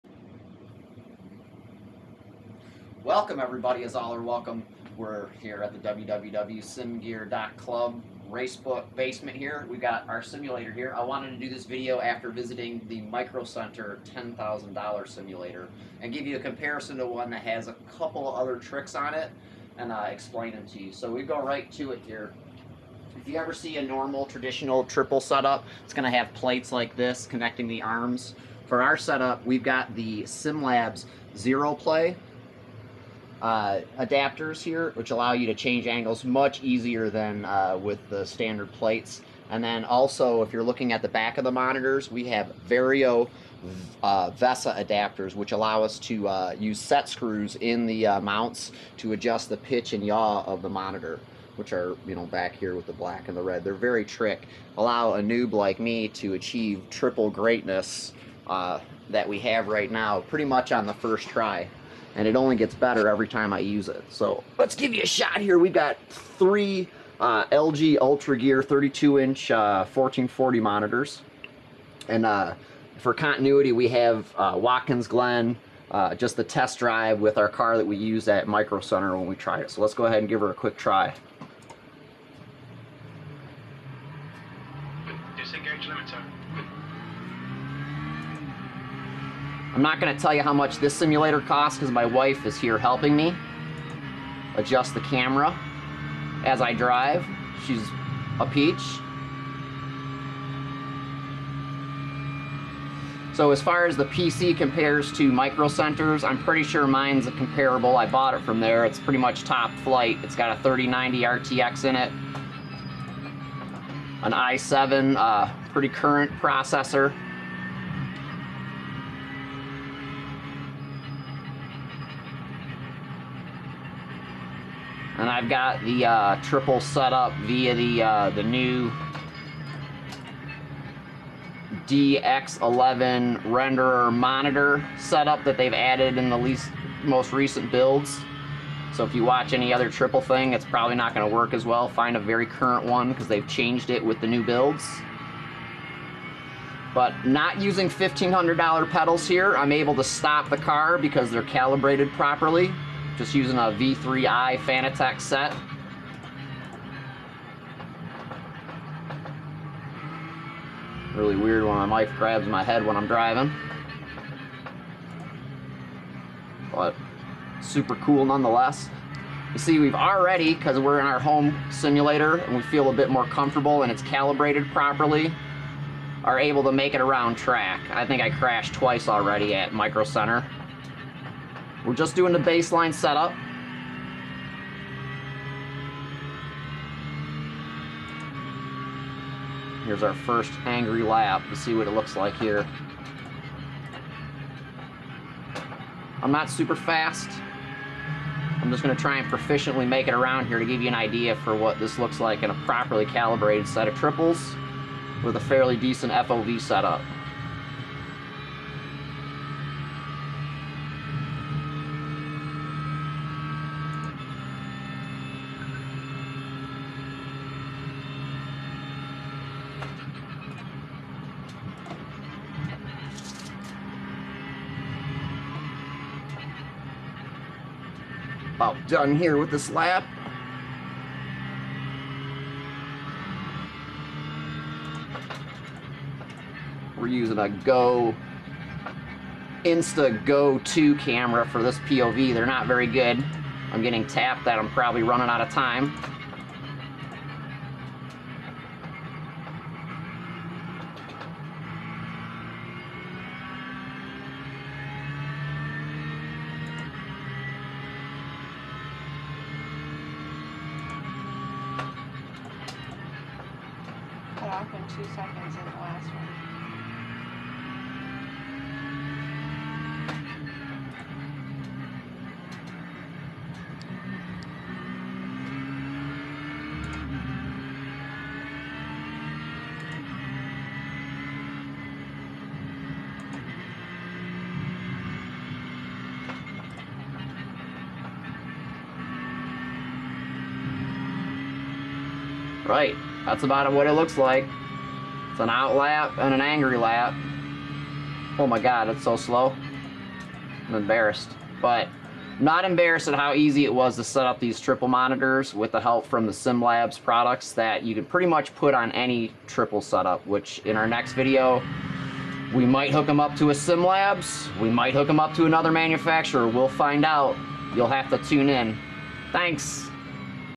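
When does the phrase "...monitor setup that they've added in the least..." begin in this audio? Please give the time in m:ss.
2:14.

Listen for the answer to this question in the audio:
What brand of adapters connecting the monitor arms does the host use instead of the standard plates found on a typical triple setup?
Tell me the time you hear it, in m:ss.
0:30.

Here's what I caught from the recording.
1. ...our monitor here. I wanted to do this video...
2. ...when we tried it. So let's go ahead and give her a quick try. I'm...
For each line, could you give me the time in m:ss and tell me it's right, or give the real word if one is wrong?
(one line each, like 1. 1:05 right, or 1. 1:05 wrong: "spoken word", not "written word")
1. 0:10 wrong: "simulator", not "monitor"
2. 1:19 right.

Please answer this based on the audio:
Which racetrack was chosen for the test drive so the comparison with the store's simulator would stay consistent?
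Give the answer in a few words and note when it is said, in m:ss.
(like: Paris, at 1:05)
Watkins Glen, at 1:14.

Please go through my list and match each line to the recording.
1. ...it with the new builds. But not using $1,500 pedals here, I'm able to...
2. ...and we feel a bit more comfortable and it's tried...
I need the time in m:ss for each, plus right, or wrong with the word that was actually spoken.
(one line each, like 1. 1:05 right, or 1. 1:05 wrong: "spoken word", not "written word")
1. 2:23 right
2. 2:52 wrong: "calibrated", not "tried".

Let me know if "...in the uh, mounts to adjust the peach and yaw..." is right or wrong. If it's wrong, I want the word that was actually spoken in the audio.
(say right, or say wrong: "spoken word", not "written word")
wrong: "pitch", not "peach".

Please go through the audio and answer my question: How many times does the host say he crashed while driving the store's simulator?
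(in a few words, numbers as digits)
twice.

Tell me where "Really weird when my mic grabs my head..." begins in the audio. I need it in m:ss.
2:41.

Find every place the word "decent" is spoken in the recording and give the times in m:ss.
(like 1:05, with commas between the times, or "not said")
3:25.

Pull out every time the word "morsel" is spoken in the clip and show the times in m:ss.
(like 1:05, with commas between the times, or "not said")
not said.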